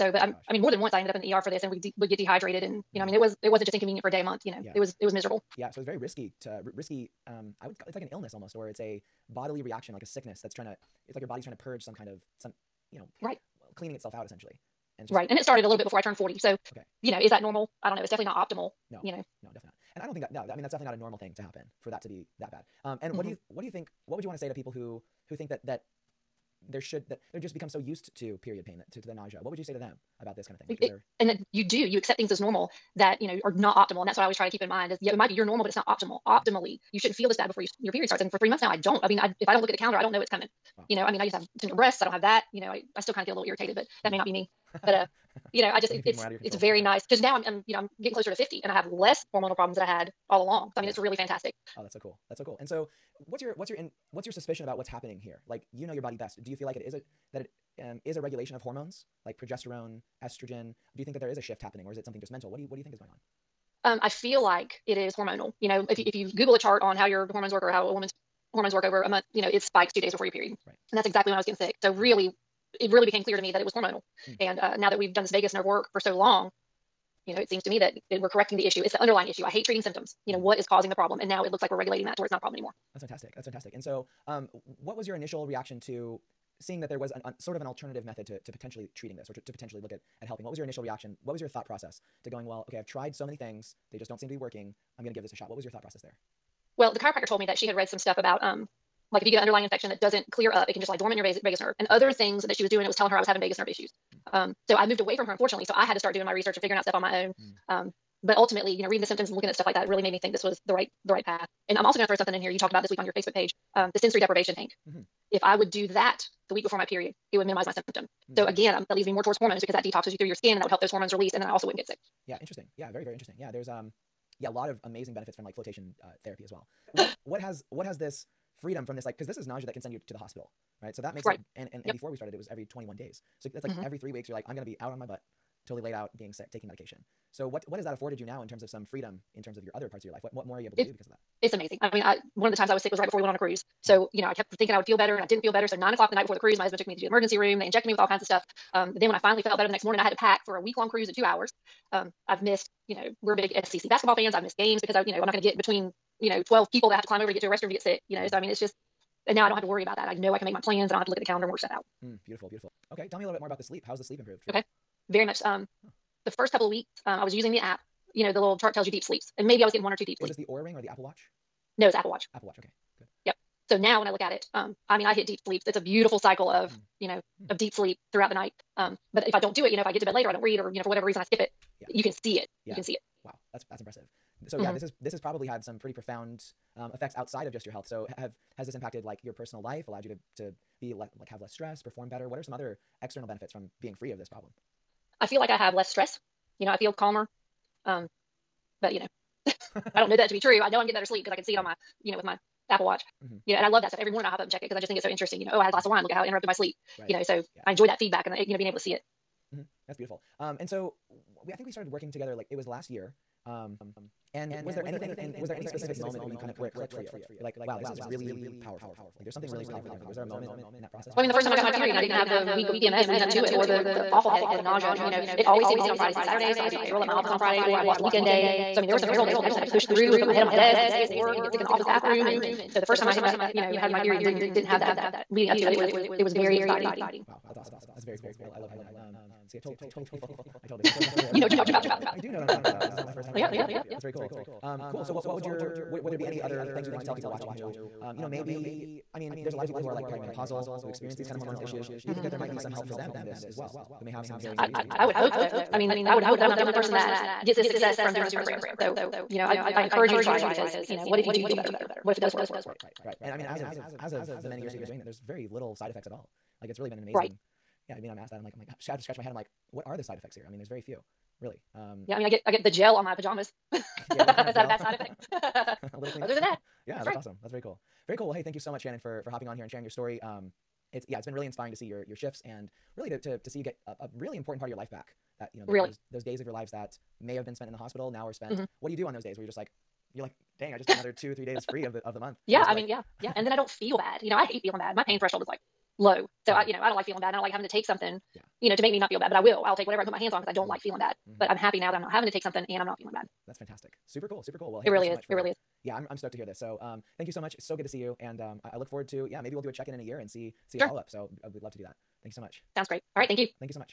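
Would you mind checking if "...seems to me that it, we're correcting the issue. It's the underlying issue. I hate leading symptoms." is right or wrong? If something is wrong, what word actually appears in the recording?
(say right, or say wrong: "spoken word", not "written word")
wrong: "treating", not "leading".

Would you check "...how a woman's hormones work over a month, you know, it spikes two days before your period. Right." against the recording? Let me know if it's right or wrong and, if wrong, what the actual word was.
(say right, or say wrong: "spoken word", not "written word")
right.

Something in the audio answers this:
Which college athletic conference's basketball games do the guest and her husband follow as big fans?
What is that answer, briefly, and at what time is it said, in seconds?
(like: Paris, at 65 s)
SEC, at 153 s.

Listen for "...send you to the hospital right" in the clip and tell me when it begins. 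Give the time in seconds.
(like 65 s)
129 s.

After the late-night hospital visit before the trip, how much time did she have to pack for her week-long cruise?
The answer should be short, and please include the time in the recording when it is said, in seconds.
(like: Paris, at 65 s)
2 hours, at 151 s.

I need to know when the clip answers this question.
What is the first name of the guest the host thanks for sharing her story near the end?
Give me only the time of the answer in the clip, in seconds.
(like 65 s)
278 s.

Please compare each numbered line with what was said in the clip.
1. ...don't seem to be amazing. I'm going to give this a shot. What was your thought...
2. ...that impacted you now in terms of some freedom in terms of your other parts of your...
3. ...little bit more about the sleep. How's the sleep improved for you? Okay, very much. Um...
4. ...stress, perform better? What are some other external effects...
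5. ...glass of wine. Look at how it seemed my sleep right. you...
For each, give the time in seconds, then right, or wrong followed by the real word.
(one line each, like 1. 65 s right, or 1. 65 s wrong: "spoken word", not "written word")
1. 94 s wrong: "working", not "amazing"
2. 137 s wrong: "afforded", not "impacted"
3. 163 s right
4. 191 s wrong: "benefits", not "effects"
5. 205 s wrong: "interrupted", not "seemed".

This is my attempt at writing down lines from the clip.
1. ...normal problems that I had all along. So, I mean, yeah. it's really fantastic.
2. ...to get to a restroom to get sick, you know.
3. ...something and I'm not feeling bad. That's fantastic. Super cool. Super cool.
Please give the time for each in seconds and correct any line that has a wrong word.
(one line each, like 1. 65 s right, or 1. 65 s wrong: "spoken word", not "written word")
1. 49 s wrong: "hormonal", not "normal"
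2. 157 s right
3. 302 s right.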